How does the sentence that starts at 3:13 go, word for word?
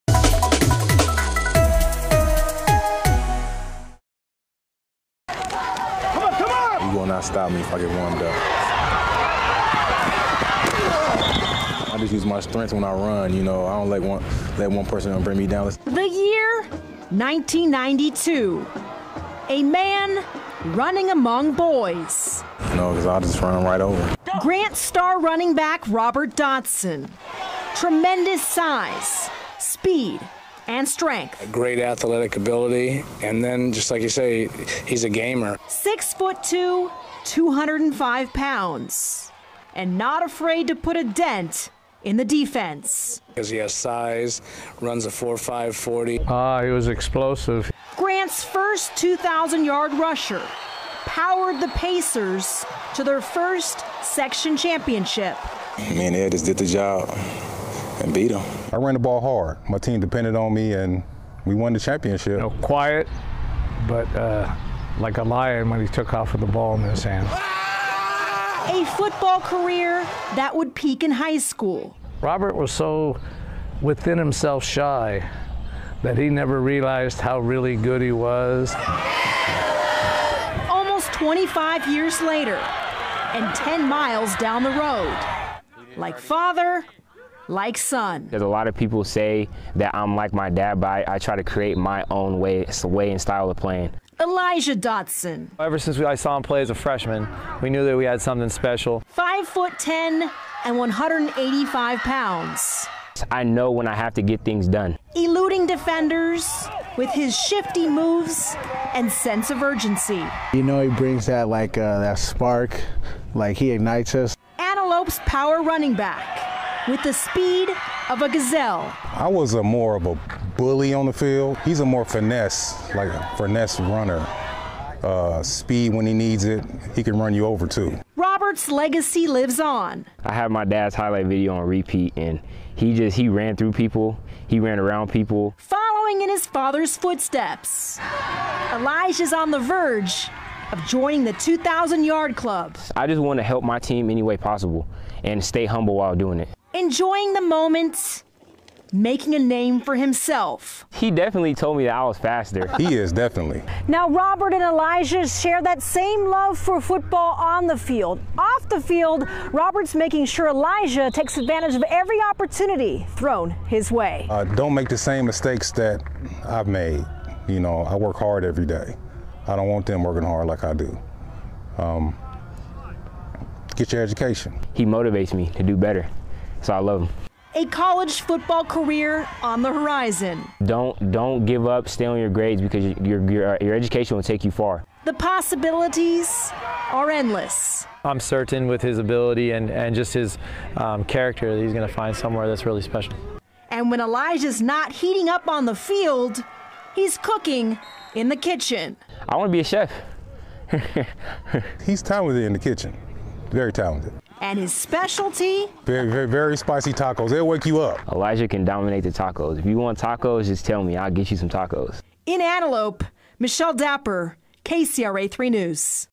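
And when Elijah's not heating up on the field, he's cooking in the kitchen.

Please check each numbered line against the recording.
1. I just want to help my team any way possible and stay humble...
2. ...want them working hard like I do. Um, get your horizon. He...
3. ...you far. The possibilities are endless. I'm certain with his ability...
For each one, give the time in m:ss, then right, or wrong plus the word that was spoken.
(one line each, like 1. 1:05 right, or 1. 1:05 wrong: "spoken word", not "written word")
1. 2:22 right
2. 2:49 wrong: "education", not "horizon"
3. 3:04 right.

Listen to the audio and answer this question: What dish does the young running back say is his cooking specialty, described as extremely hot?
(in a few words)
Spicy tacos.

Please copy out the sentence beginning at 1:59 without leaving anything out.
I was a more of a bully on the field.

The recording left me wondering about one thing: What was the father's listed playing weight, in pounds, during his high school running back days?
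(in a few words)
205.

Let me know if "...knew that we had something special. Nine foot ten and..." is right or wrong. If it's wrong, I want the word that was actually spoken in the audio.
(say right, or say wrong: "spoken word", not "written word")
wrong: "Five", not "Nine".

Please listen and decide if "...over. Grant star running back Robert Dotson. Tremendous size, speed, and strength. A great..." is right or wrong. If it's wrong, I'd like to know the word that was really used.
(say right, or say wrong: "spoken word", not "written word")
right.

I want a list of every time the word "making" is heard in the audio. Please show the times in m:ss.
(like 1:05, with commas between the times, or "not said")
2:28, 2:39.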